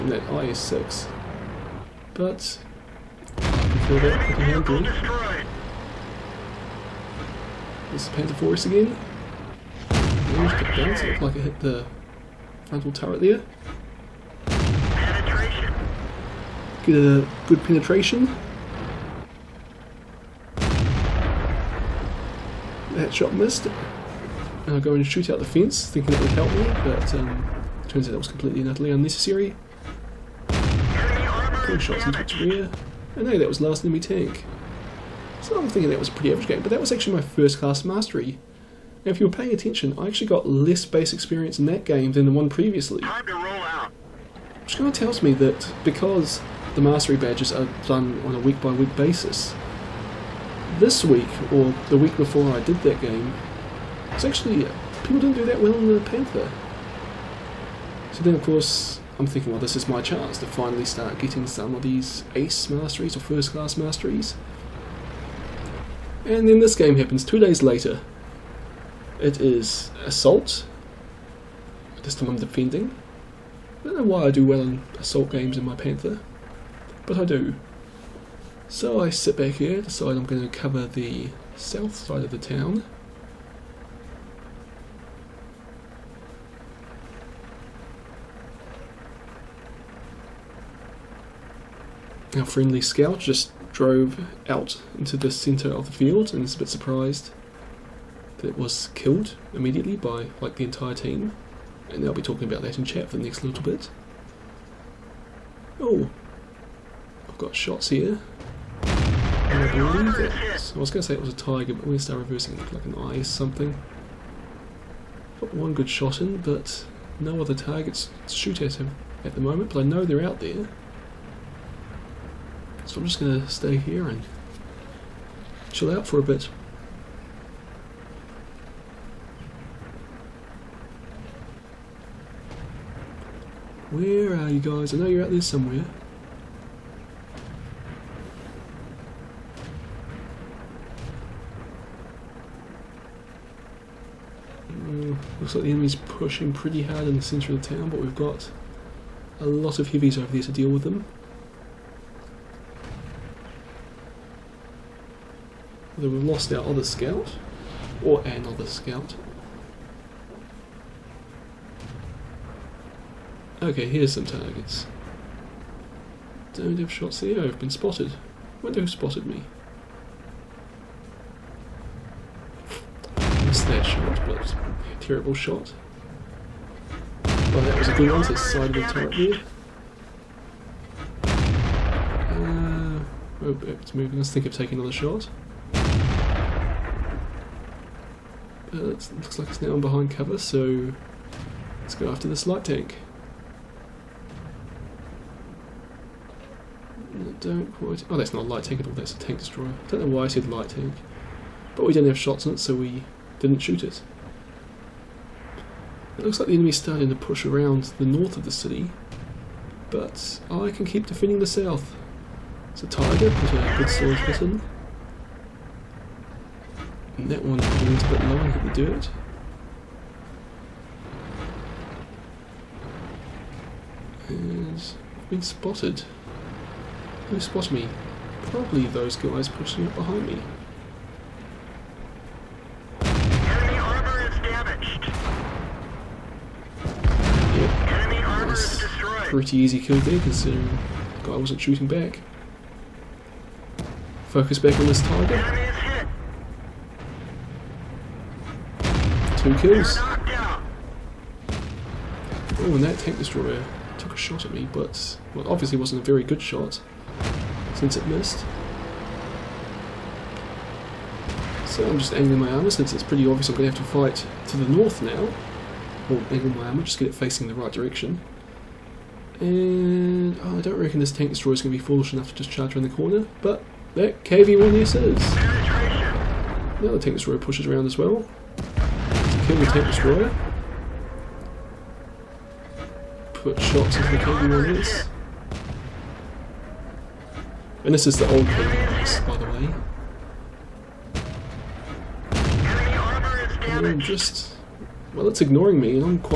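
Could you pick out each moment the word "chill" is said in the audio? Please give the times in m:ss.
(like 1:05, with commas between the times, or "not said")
2:05.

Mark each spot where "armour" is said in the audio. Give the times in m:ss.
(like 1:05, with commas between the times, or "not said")
4:22, 4:26.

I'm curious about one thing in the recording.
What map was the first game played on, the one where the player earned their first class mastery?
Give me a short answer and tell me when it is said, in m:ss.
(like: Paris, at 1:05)
Panther Forest, at 0:08.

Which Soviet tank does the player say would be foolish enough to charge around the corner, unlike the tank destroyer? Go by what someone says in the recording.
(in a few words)
KV-1.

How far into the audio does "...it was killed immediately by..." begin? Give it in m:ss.
1:38.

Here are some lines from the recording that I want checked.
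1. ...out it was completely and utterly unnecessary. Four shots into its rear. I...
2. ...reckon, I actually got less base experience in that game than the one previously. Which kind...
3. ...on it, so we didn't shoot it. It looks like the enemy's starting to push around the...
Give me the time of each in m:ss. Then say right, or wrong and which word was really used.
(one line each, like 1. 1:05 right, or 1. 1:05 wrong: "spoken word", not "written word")
1. 0:28 right
2. 0:39 wrong: "attention", not "reckon"
3. 3:22 right.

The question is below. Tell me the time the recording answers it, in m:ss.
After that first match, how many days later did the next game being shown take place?
1:07.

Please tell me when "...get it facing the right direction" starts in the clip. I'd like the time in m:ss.
4:26.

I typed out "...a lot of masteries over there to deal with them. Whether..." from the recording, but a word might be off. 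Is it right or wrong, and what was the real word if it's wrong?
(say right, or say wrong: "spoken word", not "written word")
wrong: "heavies", not "masteries".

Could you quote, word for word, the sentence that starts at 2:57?
Well, that was a good one, so side of the turret there.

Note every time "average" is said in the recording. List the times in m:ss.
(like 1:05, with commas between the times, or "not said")
0:36.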